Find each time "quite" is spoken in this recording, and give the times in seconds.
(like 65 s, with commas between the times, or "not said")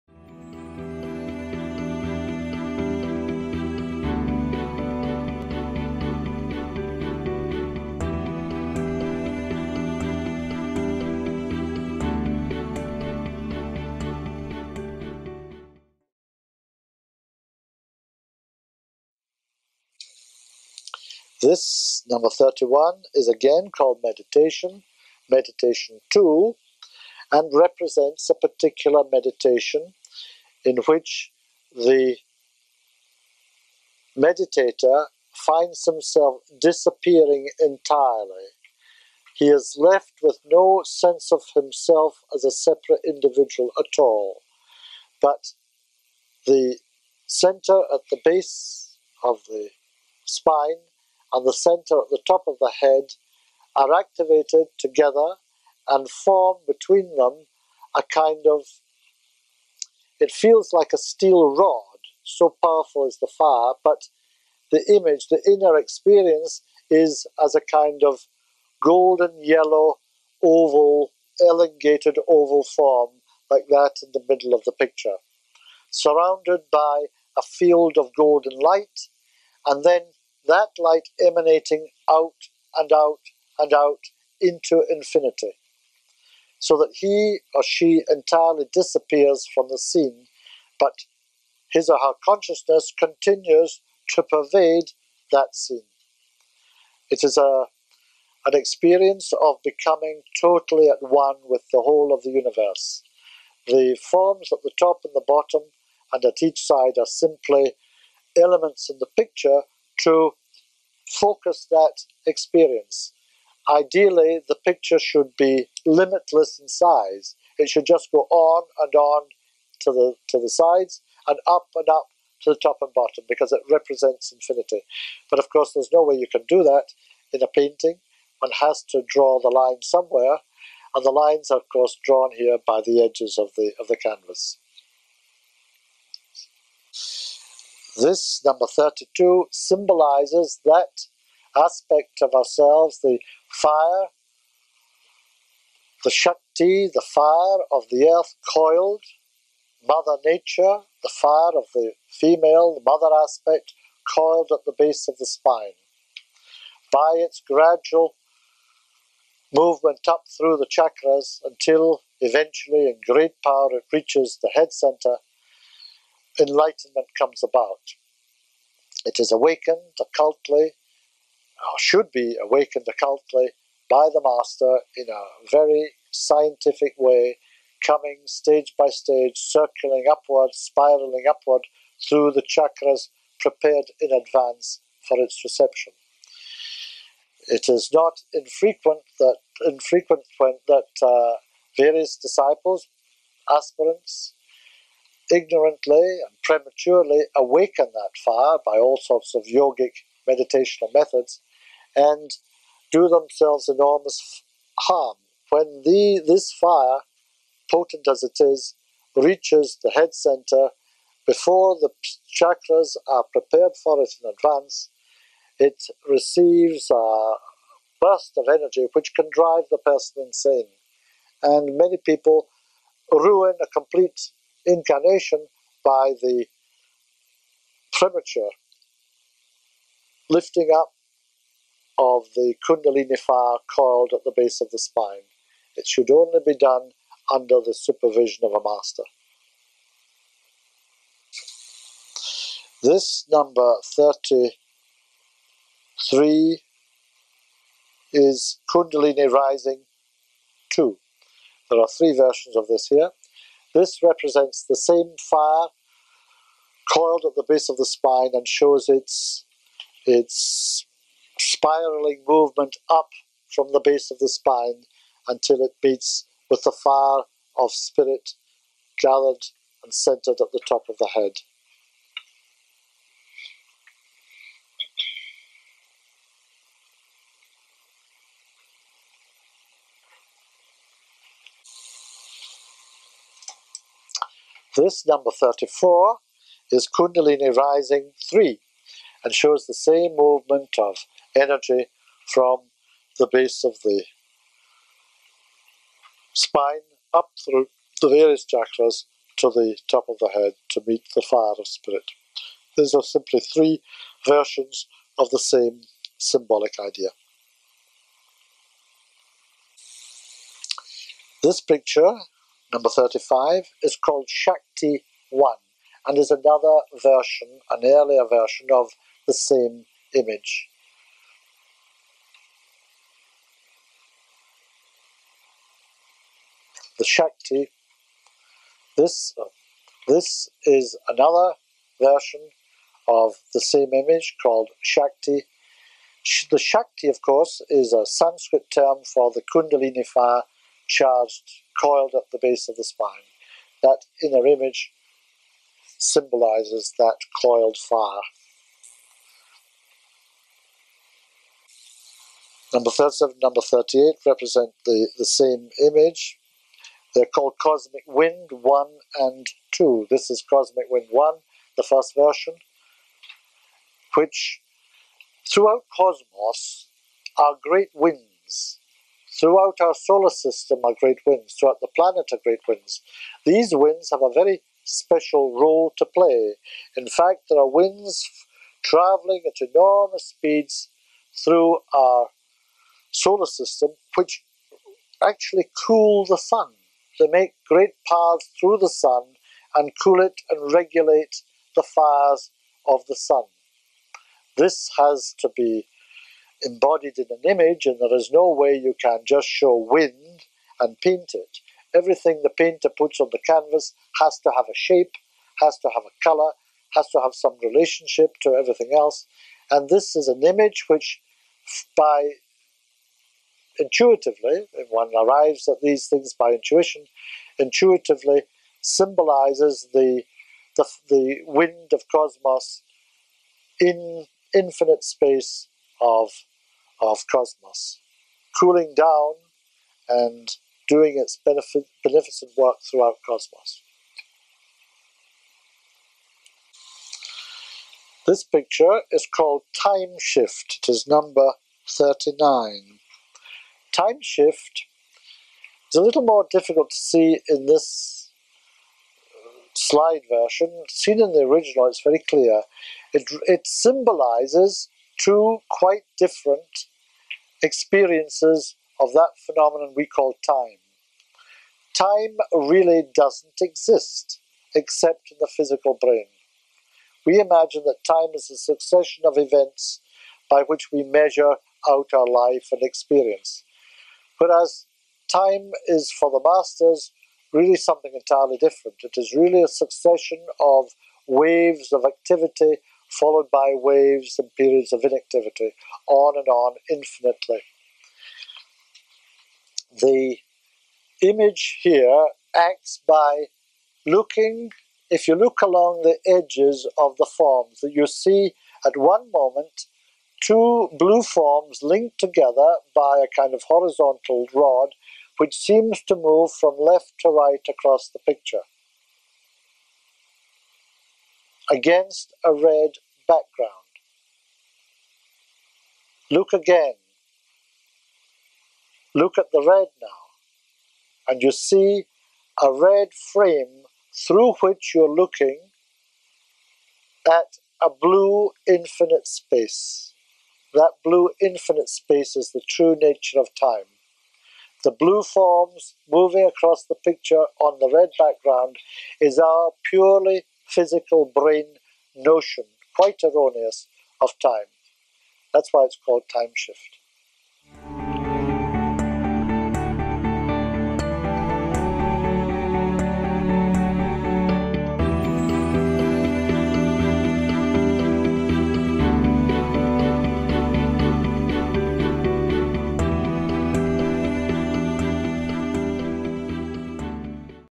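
455 s, 542 s.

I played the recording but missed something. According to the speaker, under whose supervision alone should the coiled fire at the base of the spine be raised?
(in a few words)
a master.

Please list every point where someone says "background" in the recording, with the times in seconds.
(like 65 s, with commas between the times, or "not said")
513 s, 538 s.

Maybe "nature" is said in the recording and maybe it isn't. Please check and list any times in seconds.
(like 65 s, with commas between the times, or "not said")
150 s, 533 s.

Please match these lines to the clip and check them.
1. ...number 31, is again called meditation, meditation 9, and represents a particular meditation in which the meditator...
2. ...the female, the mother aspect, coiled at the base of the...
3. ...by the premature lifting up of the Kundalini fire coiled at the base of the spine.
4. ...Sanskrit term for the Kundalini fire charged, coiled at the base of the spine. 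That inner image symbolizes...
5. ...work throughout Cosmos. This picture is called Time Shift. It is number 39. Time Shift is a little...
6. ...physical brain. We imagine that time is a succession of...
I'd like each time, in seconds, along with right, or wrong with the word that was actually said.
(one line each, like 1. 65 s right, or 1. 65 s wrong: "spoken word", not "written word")
1. 22 s wrong: "2", not "9"
2. 151 s right
3. 225 s right
4. 338 s right
5. 432 s right
6. 465 s right.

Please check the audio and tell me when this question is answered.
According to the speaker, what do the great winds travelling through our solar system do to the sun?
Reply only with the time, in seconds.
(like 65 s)
385 s.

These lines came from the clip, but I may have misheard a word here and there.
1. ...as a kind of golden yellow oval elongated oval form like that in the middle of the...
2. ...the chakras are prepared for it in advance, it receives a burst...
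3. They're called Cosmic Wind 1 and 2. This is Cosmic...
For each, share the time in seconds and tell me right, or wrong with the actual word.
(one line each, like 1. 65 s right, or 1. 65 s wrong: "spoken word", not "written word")
1. 67 s right
2. 211 s right
3. 357 s right.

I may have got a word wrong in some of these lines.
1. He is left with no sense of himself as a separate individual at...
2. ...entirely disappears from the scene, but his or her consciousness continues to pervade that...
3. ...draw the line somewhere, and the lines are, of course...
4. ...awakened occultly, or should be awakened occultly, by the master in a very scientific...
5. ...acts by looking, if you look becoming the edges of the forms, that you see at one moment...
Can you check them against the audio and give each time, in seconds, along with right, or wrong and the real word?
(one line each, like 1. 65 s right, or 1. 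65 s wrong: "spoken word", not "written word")
1. 39 s right
2. 88 s right
3. 129 s right
4. 169 s right
5. 492 s wrong: "along", not "becoming".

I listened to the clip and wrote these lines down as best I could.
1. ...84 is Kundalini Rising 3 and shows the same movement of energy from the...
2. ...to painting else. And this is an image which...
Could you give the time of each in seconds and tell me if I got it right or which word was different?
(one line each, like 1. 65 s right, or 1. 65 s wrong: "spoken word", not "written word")
1. 285 s wrong: "34", not "84"
2. 408 s wrong: "everything", not "painting".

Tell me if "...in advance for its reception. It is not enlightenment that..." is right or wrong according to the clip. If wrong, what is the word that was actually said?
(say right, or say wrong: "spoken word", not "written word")
wrong: "infrequent", not "enlightenment".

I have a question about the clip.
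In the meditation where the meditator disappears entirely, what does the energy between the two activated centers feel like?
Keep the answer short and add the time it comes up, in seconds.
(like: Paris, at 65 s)
a steel rod, at 60 s.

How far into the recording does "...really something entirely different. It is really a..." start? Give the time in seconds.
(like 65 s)
477 s.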